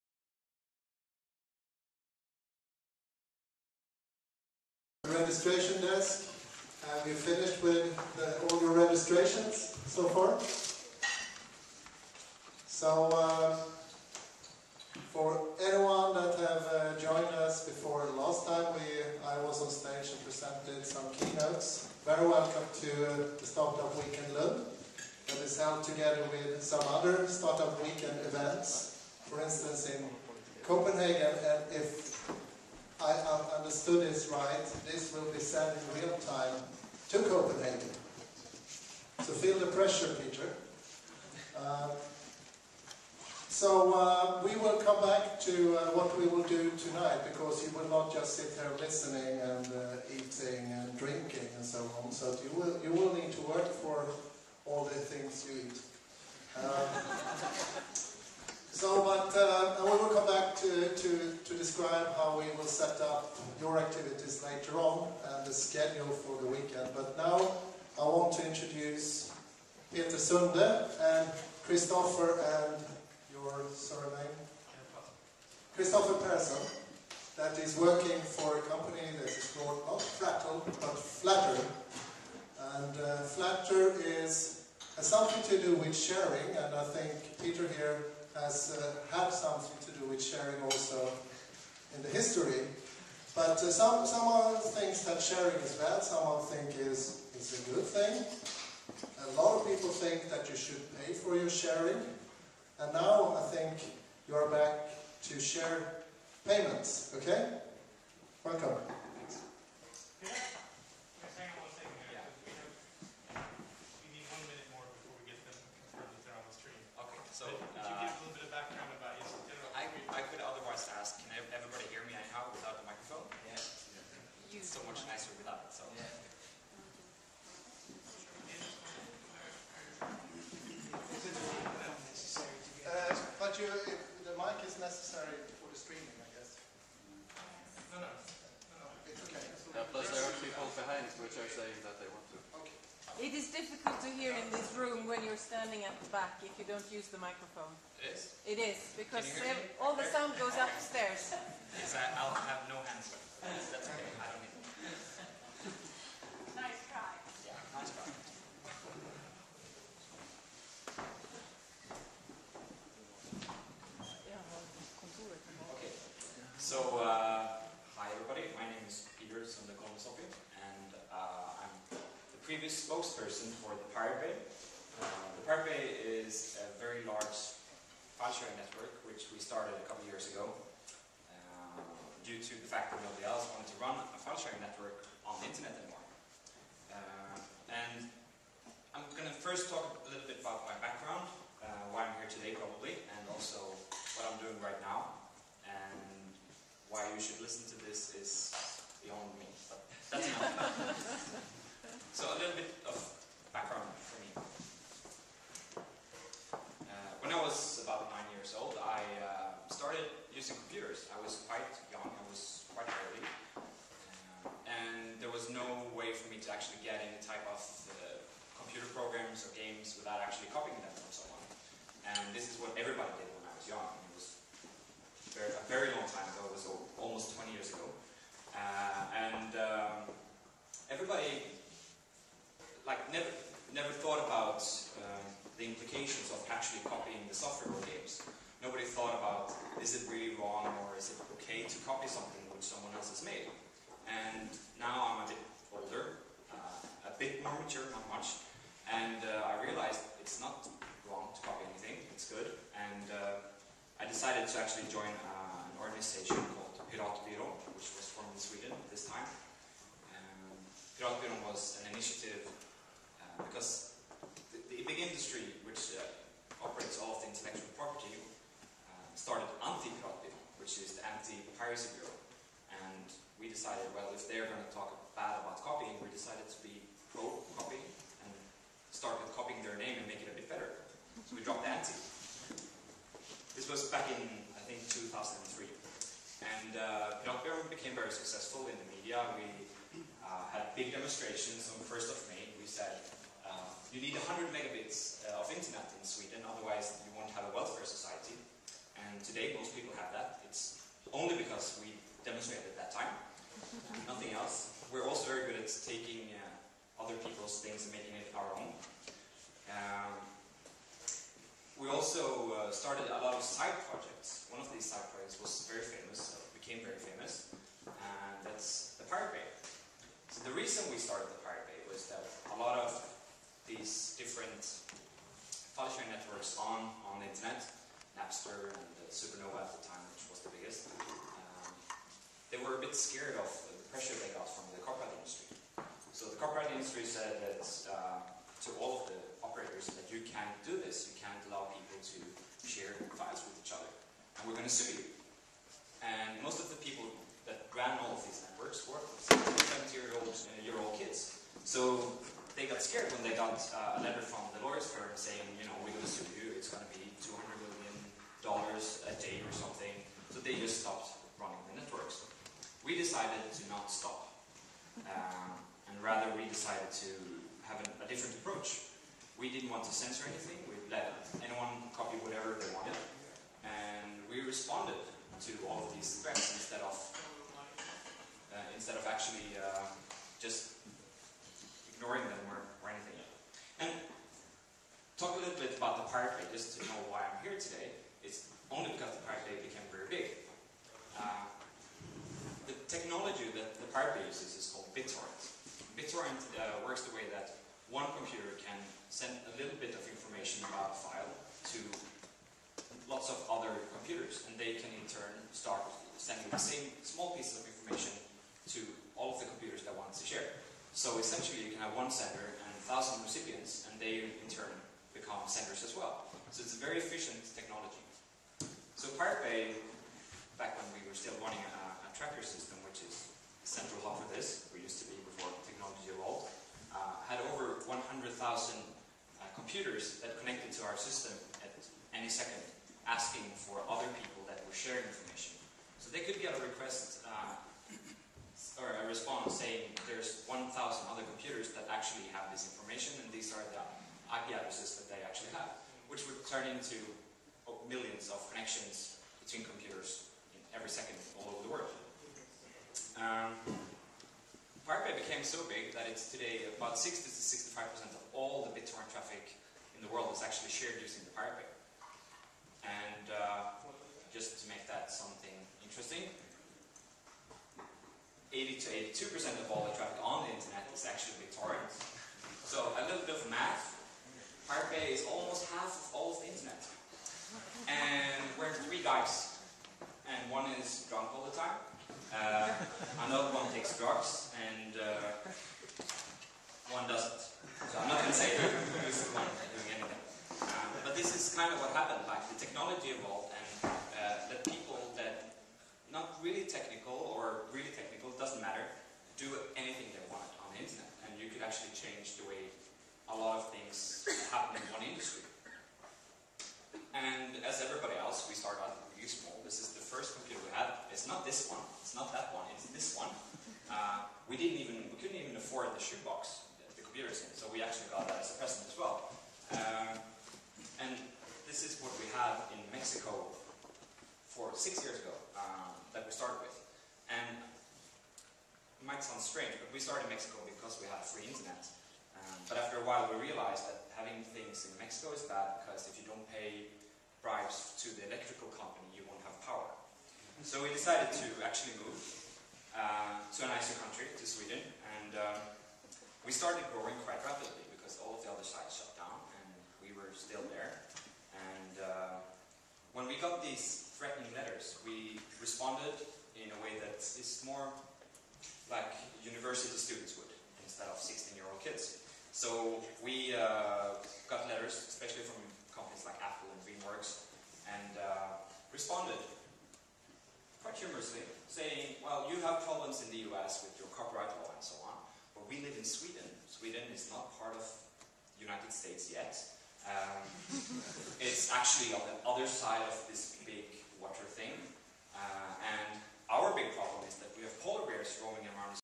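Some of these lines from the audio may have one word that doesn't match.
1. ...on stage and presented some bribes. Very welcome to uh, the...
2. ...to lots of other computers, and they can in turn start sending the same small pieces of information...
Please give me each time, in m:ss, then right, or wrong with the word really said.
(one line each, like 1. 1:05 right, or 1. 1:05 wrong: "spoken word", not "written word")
1. 0:19 wrong: "keynotes", not "bribes"
2. 6:41 right.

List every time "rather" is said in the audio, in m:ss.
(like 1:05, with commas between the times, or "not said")
6:06.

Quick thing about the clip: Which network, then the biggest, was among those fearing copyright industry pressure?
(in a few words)
Suprnova.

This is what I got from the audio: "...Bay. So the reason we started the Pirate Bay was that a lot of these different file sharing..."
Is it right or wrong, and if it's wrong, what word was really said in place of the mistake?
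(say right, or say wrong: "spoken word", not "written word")
right.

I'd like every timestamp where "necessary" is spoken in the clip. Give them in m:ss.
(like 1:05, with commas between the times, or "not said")
2:14.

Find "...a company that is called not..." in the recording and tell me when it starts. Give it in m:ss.
1:18.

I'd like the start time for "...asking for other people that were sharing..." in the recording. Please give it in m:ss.
7:13.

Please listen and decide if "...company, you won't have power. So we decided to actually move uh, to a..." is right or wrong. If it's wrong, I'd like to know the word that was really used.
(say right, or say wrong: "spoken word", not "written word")
right.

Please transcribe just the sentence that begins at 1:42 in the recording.
And now I think you're back to share payments, okay?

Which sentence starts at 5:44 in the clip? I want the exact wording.
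And we're going to sue you.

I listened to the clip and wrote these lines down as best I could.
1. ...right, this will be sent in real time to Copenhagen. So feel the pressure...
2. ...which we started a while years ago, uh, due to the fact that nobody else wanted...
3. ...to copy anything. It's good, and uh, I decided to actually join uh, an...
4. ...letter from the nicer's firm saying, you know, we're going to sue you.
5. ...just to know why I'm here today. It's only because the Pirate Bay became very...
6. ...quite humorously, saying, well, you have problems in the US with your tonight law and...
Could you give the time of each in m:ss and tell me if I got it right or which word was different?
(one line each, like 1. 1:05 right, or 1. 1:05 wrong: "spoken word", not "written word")
1. 0:34 right
2. 2:59 wrong: "couple", not "while"
3. 4:11 right
4. 5:54 wrong: "lawyer", not "nicer"
5. 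6:26 right
6. 9:30 wrong: "copyright", not "tonight".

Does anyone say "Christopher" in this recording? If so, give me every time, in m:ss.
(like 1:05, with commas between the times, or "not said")
1:11, 1:15.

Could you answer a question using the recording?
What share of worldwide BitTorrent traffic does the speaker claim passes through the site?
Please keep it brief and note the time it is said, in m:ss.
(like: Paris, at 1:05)
60 to 65%, at 7:36.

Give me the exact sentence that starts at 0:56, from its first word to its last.
Um, so, but uh, to, to, describe how we will set up your activities later on and the schedule for the weekend.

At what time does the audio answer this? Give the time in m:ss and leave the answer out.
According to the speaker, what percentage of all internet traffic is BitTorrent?
7:48.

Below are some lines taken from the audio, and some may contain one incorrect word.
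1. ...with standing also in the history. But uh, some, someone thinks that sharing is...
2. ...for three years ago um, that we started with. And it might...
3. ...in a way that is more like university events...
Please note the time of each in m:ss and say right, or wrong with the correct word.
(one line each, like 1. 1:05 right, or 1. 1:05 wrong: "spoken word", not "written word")
1. 1:30 wrong: "sharing", not "standing"
2. 8:44 wrong: "six", not "three"
3. 9:16 wrong: "students", not "events".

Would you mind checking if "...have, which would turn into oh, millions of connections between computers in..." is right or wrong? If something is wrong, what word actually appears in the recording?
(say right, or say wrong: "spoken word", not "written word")
right.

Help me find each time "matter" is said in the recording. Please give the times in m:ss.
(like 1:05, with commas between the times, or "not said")
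8:18.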